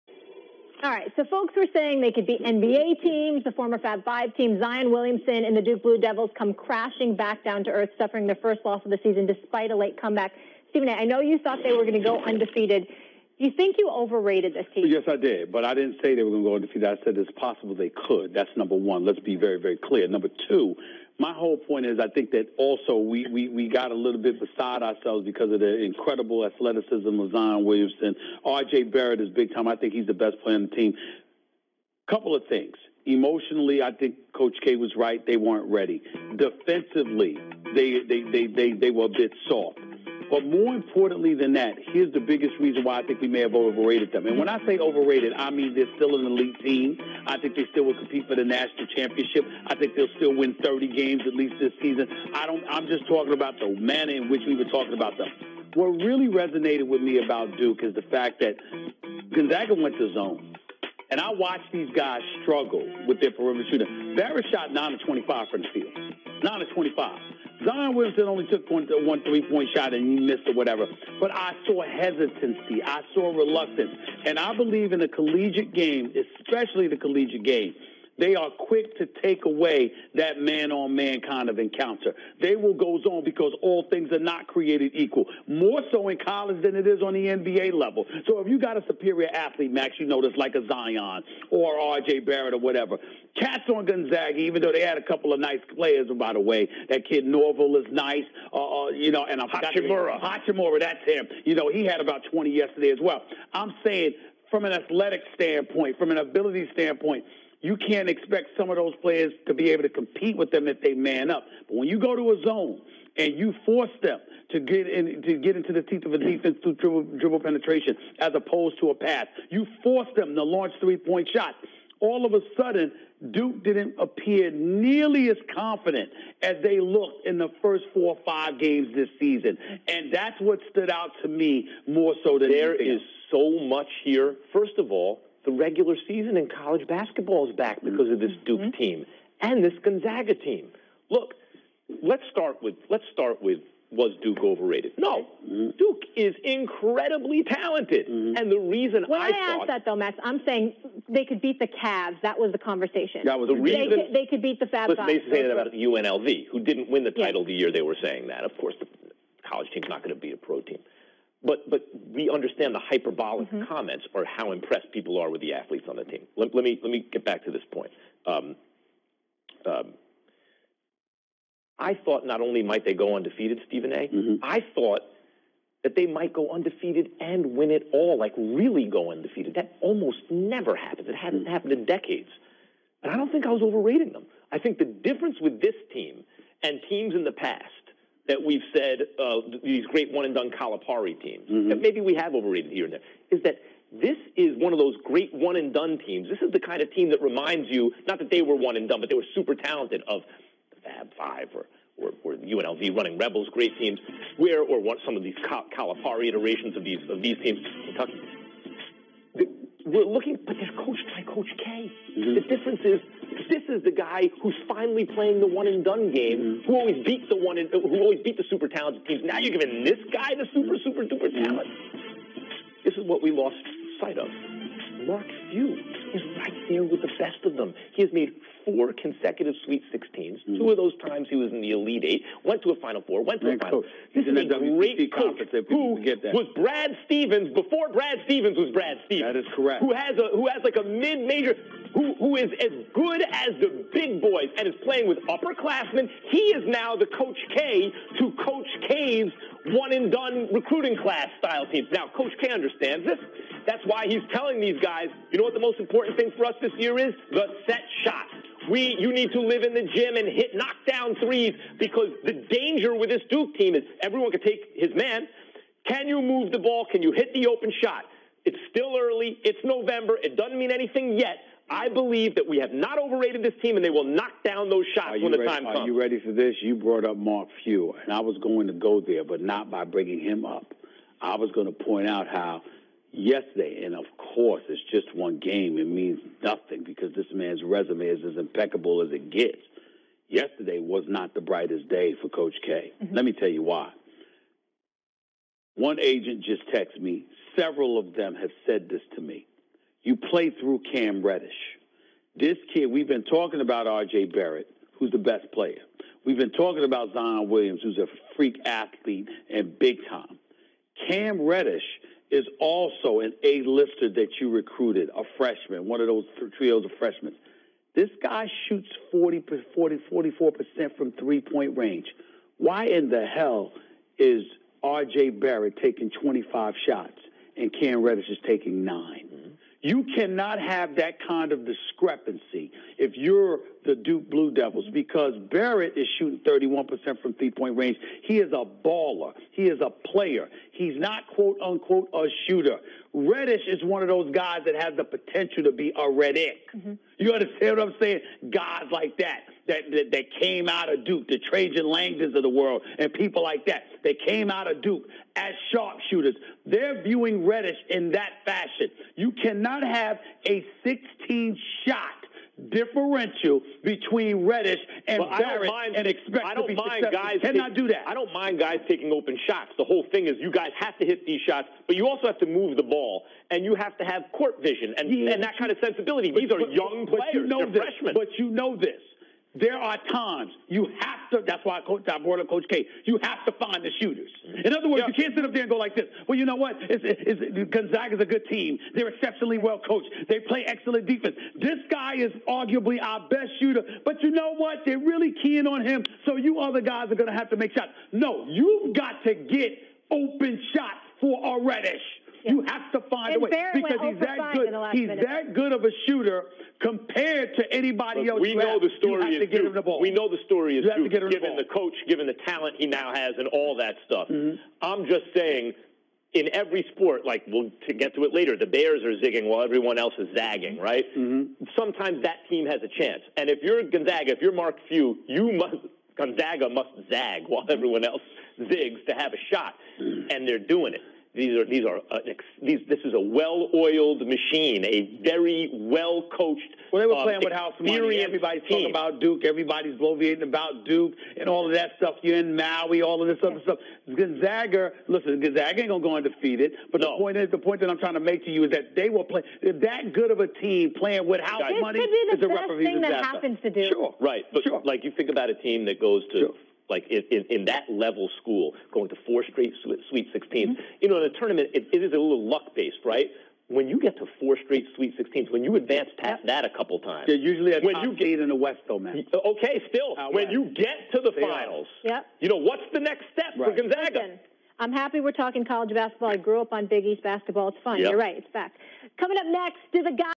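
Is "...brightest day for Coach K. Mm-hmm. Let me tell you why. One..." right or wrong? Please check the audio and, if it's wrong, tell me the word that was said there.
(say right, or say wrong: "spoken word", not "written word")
right.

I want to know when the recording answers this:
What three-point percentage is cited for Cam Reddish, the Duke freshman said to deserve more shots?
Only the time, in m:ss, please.
5:20.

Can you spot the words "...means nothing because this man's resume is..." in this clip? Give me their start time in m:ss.
4:45.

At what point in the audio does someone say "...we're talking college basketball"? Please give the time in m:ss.
7:55.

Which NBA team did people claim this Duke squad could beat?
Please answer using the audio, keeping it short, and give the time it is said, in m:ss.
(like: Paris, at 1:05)
Cavs, at 2:31.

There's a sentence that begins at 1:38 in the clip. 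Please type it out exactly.
Uh, uh, you know, and I'm Hachimura.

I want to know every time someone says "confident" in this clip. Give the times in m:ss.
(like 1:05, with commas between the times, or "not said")
2:05.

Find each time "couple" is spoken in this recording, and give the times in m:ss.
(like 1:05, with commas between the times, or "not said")
0:32, 1:35, 7:46.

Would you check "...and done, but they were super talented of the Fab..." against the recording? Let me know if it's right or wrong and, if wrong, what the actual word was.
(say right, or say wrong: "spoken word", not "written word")
right.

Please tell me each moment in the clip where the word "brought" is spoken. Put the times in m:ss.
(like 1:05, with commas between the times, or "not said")
4:36, 6:22.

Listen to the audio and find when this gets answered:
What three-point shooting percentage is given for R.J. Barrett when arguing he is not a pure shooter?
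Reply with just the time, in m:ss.
5:36.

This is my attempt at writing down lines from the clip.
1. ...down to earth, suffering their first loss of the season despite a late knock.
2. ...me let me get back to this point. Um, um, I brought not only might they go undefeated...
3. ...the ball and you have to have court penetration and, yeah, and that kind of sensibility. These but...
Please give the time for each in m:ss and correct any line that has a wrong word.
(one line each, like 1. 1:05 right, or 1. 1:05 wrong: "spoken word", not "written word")
1. 0:07 wrong: "comeback", not "knock"
2. 2:46 wrong: "thought", not "brought"
3. 6:12 wrong: "vision", not "penetration".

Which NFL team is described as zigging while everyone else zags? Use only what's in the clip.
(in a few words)
Bears.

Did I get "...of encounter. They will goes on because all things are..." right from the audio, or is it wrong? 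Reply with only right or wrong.
right.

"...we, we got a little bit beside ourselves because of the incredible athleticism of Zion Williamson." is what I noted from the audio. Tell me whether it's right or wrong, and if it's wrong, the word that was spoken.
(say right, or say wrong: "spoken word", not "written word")
right.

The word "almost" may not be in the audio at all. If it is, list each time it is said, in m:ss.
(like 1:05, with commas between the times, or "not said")
2:59.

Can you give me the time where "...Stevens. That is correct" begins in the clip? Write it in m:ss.
3:59.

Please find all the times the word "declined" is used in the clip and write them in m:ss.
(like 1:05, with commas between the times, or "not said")
not said.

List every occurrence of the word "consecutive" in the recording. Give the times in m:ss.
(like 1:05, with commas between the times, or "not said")
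3:48.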